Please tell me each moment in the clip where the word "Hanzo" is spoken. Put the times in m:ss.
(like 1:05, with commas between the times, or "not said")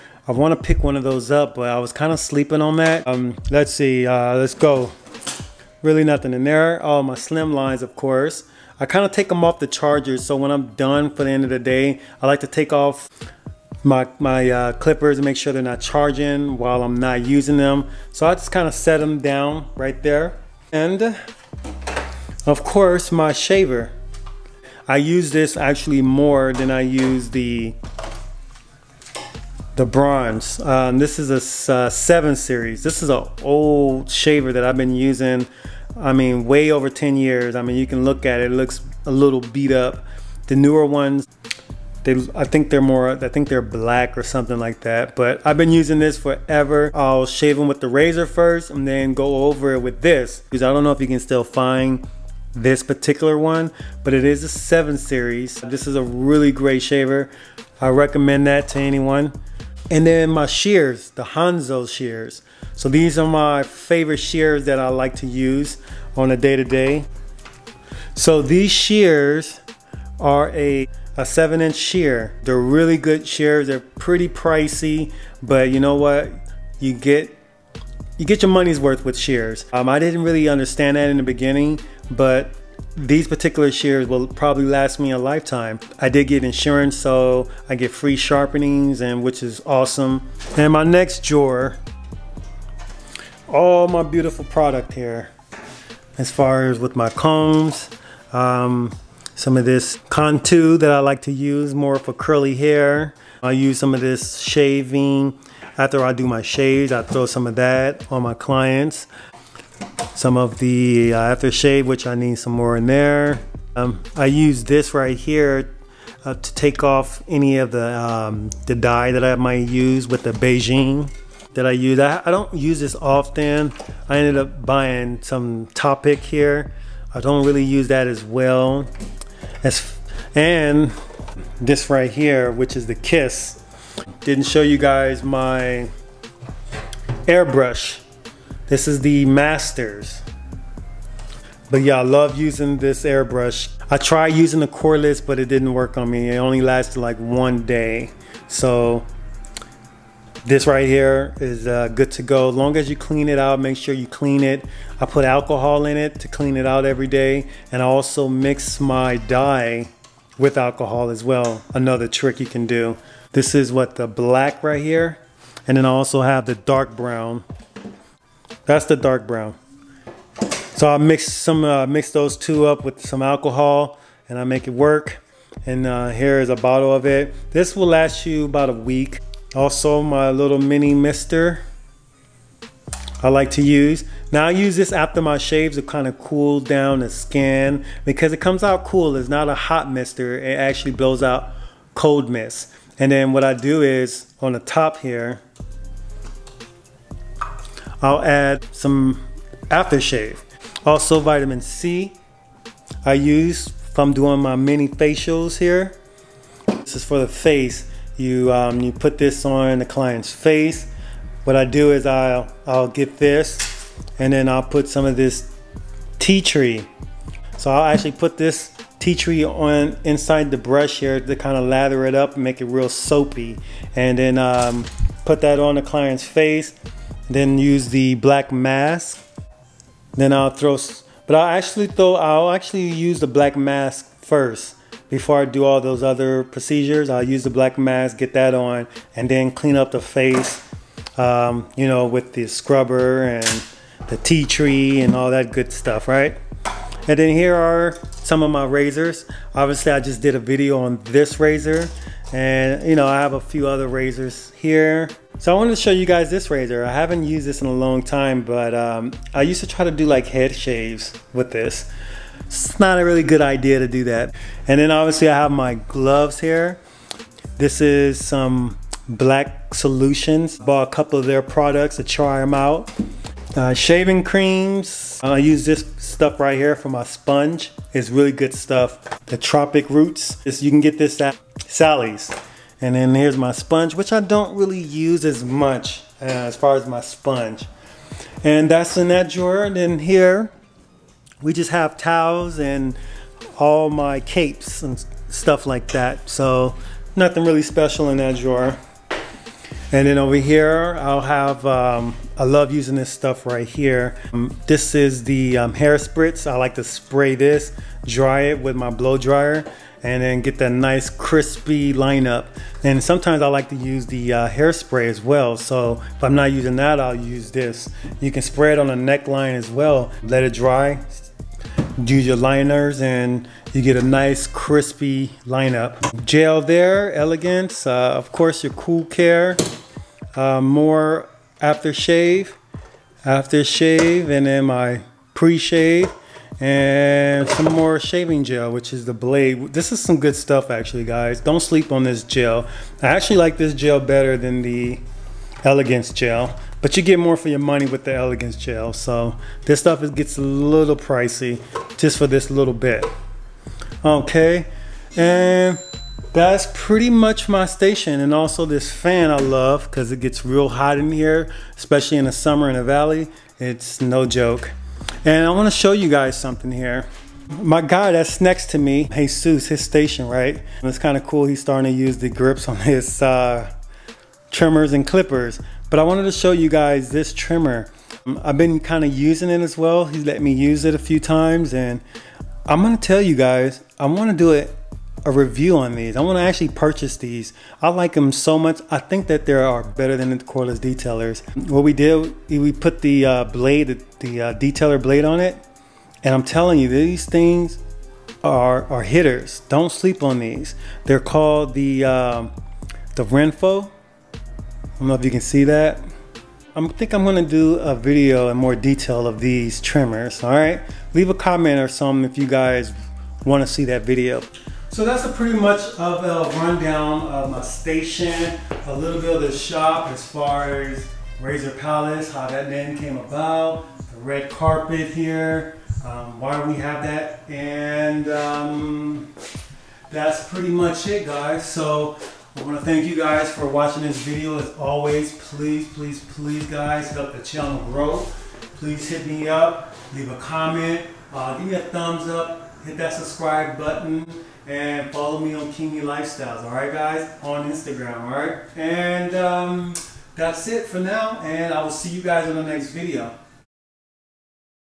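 1:01.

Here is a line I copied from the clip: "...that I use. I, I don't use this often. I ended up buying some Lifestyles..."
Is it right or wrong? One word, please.
wrong.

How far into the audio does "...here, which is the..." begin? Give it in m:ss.
2:12.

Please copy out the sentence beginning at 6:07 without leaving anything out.
My guy that's next to me, Jesus, his station, right?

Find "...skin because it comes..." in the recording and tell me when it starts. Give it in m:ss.
3:07.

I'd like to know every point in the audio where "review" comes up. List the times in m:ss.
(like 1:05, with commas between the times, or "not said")
6:25.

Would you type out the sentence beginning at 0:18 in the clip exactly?
So I just kind of set them down right there.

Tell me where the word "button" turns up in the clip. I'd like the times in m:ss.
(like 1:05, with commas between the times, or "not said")
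7:23.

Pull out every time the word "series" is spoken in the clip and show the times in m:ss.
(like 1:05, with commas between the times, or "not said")
0:32, 0:54.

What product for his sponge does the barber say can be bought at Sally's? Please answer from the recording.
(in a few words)
Tropic Roots.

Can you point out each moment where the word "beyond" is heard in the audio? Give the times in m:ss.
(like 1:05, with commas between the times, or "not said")
not said.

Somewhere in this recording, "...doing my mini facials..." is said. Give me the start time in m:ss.
3:24.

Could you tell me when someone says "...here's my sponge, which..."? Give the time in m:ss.
4:43.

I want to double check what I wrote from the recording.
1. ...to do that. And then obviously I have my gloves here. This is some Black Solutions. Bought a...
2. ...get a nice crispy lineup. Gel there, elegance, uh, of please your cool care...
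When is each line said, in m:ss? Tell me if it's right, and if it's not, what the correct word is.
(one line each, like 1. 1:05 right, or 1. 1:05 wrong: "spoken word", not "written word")
1. 4:23 right
2. 5:23 wrong: "course", not "please".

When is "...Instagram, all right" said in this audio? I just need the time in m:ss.
7:27.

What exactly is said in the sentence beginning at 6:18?
I've been kind of using it as well.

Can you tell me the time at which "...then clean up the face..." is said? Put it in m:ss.
3:59.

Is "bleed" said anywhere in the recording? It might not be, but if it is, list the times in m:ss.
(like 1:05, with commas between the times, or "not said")
not said.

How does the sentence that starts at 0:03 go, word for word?
Um, let's see, uh, let's go.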